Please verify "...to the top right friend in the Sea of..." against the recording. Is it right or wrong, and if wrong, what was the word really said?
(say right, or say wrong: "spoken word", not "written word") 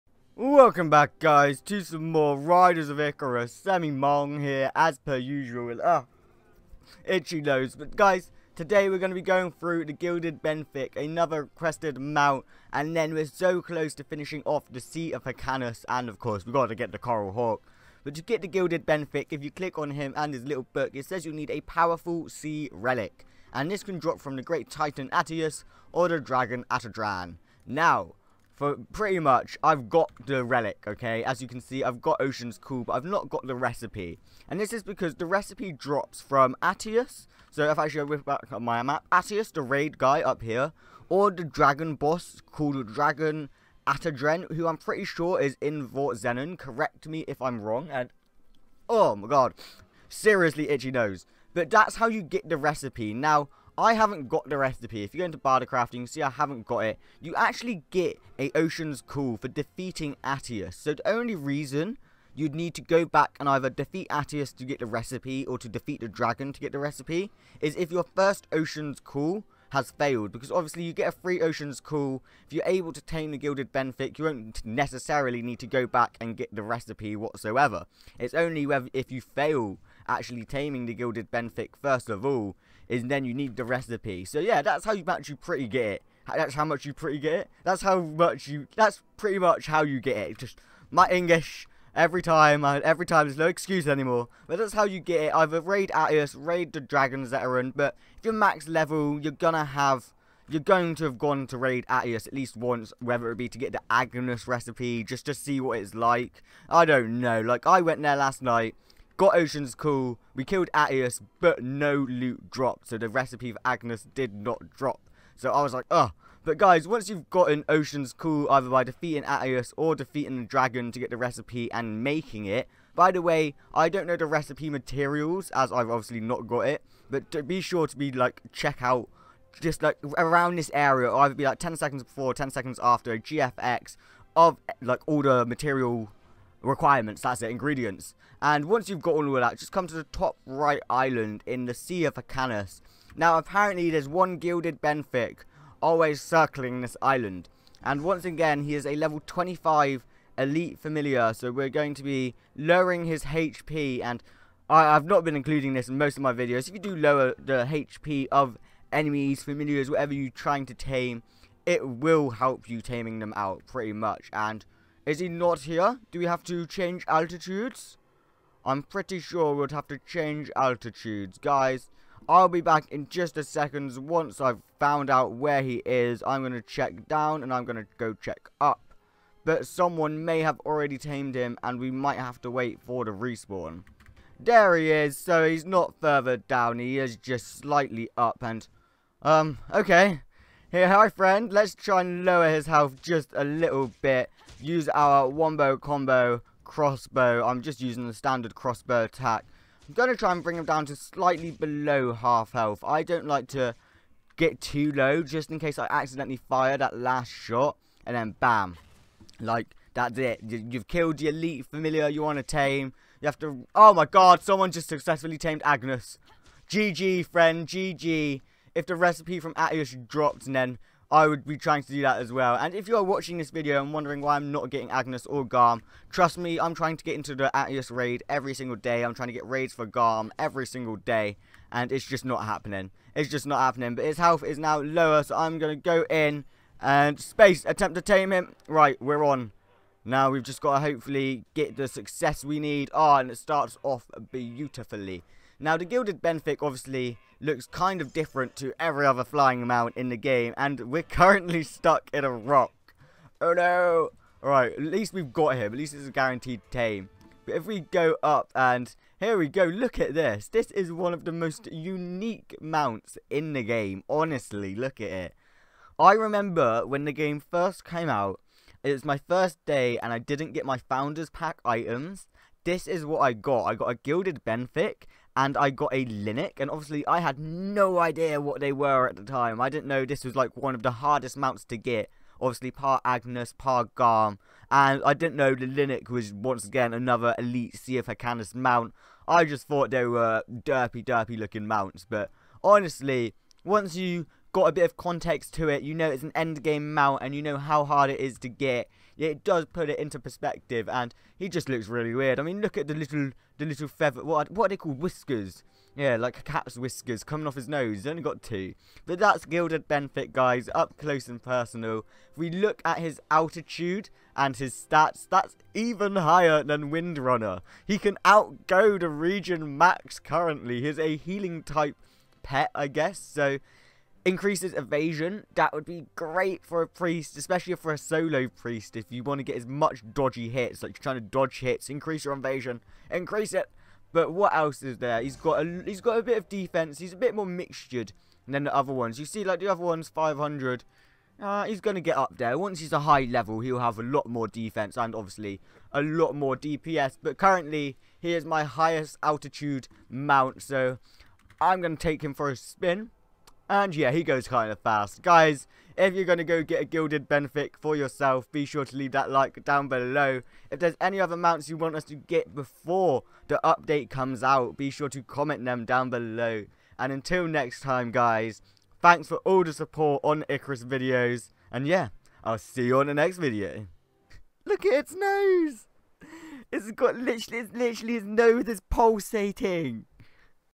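wrong: "island", not "friend".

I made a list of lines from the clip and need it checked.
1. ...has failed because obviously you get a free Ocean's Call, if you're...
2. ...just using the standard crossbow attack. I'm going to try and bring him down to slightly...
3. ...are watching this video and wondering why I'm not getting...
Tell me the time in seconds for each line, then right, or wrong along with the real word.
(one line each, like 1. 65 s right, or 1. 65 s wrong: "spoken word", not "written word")
1. 69 s right
2. 197 s right
3. 222 s right.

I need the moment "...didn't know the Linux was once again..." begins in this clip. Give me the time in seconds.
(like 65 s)
285 s.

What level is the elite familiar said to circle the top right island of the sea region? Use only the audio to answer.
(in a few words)
25.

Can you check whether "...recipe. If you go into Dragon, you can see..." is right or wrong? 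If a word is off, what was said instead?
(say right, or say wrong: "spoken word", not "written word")
wrong: "Bardercraft", not "Dragon".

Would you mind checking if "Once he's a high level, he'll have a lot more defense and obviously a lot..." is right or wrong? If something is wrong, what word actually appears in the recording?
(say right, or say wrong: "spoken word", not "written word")
right.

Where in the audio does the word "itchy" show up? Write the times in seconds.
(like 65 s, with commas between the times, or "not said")
7 s, 50 s.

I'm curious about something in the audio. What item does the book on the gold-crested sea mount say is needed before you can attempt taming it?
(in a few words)
Powerful sea relic.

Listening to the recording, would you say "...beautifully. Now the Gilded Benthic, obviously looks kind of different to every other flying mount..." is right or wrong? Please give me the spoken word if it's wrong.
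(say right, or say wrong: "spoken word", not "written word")
right.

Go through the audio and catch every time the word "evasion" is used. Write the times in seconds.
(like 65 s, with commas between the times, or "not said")
324 s, 332 s.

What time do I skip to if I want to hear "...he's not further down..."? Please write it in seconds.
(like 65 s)
185 s.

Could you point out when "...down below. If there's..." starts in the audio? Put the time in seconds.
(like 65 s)
359 s.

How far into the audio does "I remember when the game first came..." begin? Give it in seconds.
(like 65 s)
265 s.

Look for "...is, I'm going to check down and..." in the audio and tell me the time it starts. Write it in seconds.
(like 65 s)
175 s.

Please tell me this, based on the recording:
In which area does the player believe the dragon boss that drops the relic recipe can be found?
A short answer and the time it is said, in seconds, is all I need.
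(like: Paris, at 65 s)
Vort Zenon, at 45 s.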